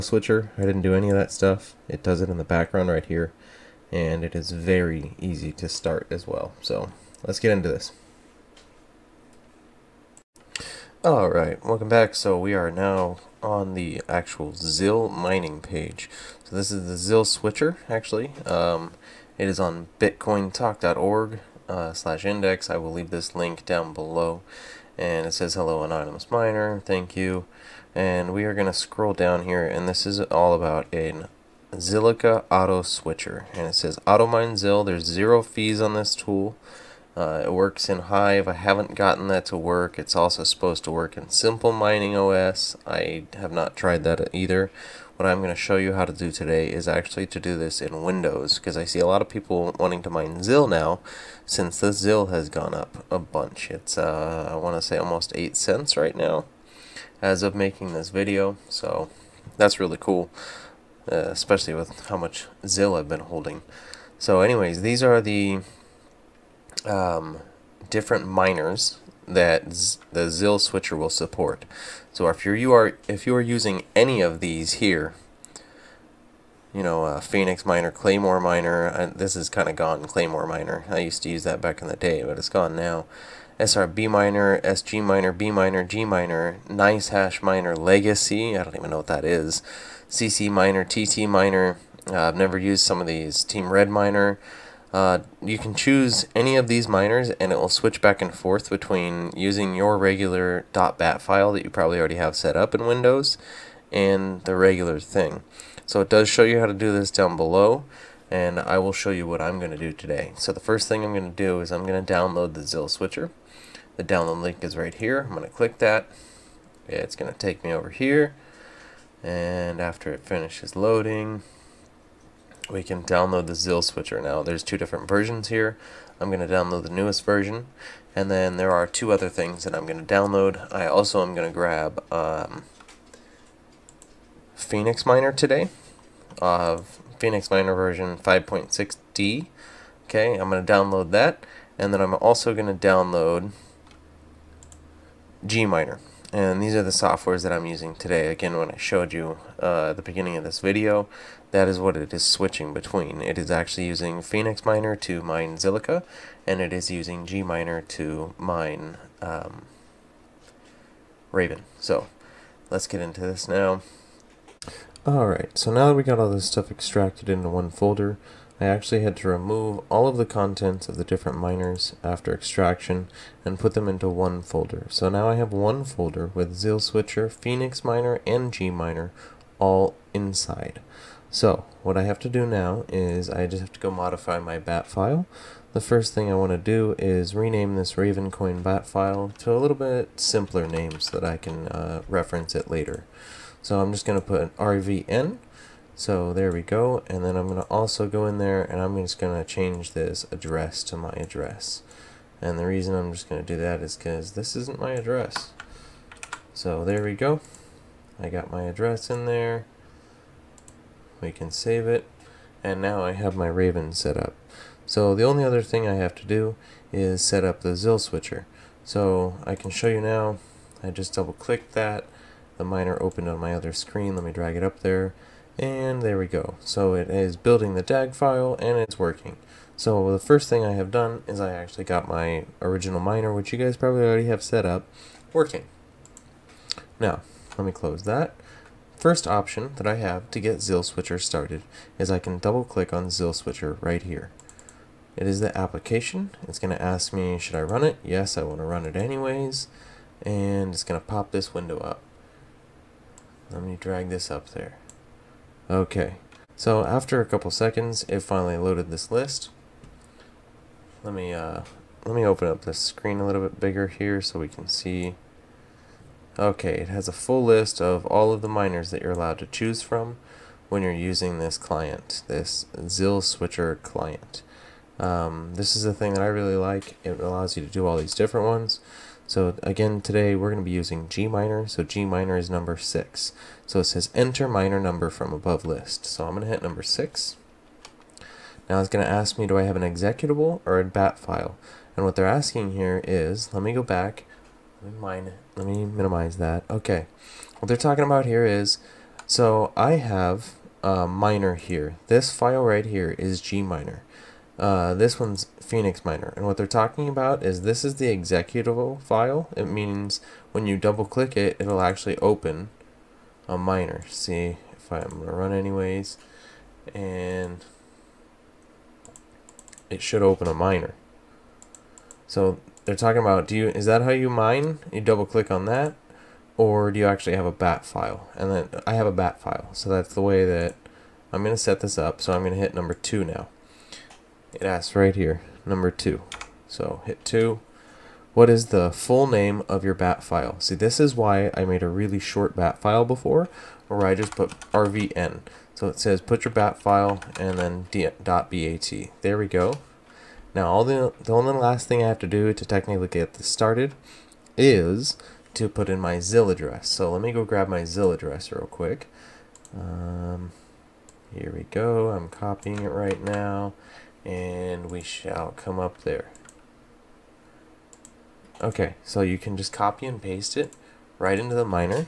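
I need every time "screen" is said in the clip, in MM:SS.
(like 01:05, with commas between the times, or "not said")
03:43, 04:22.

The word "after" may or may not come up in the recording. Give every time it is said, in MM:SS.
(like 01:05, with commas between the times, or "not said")
01:59, 02:52, 04:16.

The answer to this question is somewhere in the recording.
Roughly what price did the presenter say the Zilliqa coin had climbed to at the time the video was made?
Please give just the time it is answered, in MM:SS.
00:55.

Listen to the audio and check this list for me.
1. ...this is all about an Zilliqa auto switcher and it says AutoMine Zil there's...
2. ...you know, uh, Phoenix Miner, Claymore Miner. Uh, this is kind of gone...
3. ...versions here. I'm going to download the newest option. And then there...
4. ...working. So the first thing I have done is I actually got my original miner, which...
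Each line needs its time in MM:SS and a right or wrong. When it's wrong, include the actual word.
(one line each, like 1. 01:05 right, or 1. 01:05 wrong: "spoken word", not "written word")
1. 00:29 right
2. 01:16 right
3. 02:05 wrong: "version", not "option"
4. 03:48 right.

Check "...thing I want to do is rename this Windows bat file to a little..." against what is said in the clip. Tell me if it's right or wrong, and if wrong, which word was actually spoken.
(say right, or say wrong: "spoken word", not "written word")
wrong: "Ravencoin", not "Windows".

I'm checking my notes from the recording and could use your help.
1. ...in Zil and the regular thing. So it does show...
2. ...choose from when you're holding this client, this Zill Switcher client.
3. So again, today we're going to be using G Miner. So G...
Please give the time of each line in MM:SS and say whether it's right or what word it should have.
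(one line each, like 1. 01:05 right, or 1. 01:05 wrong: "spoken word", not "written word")
1. 01:42 wrong: "Windows", not "Zil"
2. 04:29 wrong: "using", not "holding"
3. 04:39 right.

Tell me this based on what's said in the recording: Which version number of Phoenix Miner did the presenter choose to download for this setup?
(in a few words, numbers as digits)
5.6D.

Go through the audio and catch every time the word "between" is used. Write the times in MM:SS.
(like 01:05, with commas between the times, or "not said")
01:38, 02:32.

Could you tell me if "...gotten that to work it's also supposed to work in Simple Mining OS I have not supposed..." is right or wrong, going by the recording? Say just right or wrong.
wrong.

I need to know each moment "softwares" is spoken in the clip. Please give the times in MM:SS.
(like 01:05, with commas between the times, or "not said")
02:26.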